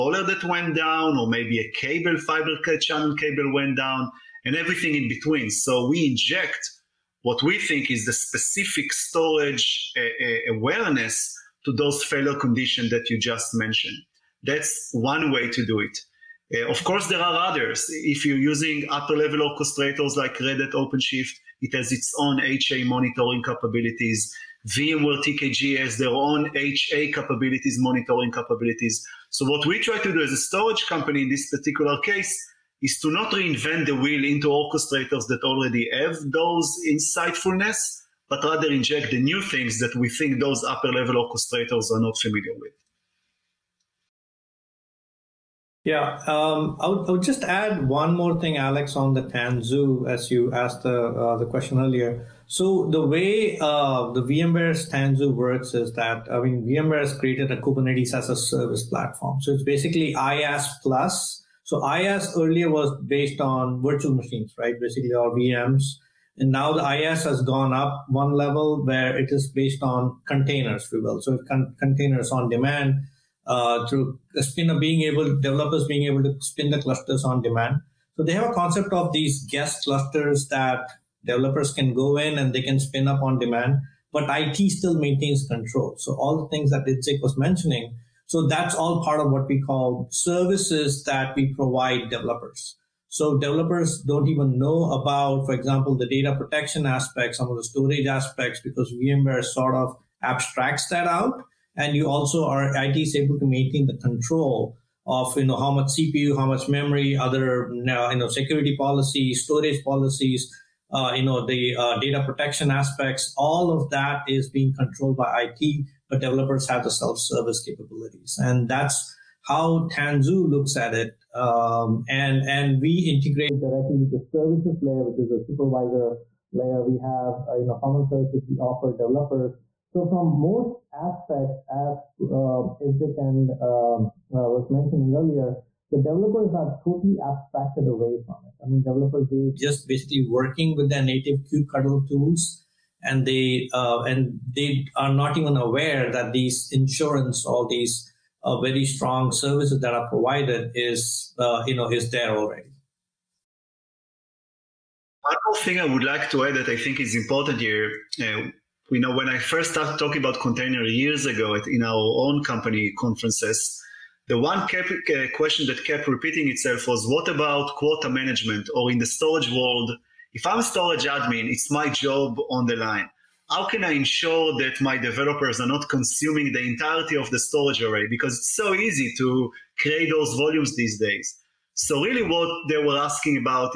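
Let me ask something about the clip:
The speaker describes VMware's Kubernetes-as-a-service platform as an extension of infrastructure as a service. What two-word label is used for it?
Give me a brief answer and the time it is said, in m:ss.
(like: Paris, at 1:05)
IaaS plus, at 1:00.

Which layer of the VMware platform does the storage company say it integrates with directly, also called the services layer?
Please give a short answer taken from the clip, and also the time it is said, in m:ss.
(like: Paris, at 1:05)
supervisor layer, at 2:05.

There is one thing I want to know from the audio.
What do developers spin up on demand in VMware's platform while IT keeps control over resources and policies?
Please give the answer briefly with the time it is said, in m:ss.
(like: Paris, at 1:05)
guest clusters, at 1:19.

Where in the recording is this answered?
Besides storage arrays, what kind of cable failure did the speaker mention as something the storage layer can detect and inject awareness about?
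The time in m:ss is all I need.
0:02.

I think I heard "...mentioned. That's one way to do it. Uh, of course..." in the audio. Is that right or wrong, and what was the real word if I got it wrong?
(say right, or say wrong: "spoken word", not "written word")
right.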